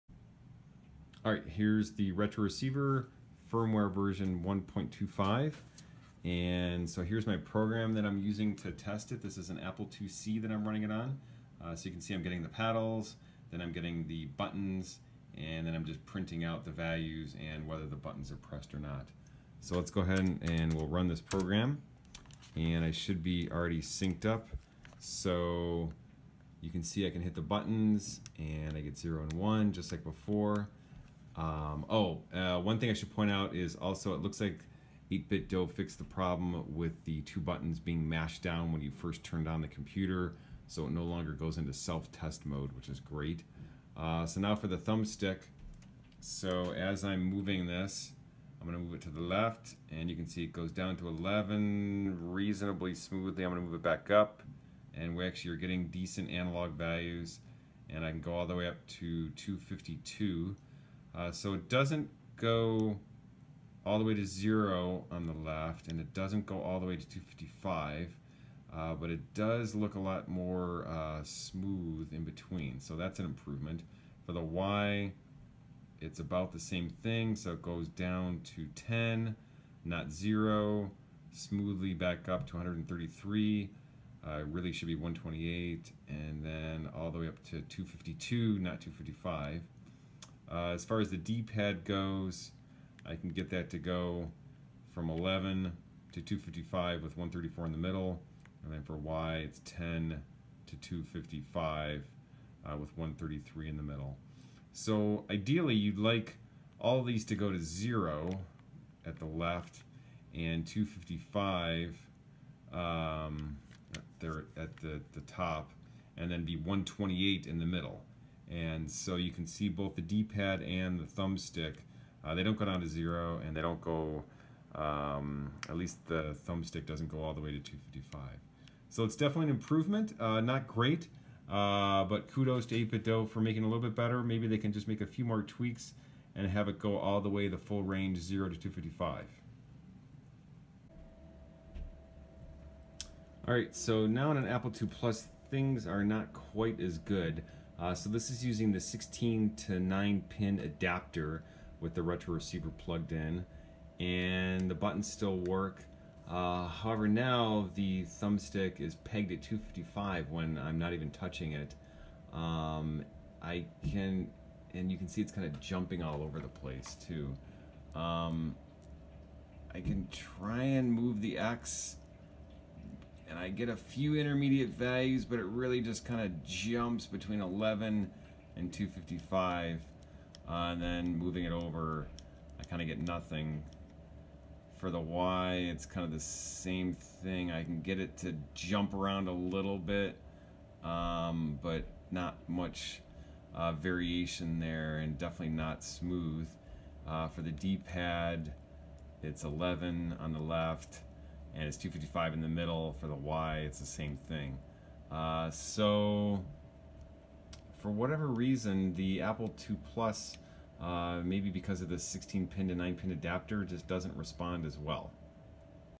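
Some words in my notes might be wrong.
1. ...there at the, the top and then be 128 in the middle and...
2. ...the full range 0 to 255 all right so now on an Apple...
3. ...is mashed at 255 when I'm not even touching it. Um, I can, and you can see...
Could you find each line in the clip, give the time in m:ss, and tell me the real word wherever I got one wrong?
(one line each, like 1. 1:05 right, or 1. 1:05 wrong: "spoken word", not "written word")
1. 1:54 right
2. 2:17 right
3. 2:38 wrong: "pegged", not "mashed".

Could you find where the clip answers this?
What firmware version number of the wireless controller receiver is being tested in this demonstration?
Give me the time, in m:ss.
0:04.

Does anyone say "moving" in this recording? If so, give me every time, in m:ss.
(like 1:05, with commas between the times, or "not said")
0:47, 3:01.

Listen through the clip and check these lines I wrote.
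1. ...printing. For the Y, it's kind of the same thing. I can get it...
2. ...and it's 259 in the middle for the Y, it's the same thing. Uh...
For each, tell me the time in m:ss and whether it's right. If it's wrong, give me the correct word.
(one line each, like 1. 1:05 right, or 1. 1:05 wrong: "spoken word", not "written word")
1. 3:02 wrong: "nothing", not "printing"
2. 3:21 wrong: "255", not "259".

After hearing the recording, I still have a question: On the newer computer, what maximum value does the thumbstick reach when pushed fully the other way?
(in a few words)
252.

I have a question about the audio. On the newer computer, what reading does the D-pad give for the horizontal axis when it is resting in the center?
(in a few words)
134.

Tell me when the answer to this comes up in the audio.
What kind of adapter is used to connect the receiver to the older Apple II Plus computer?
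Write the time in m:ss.
2:28.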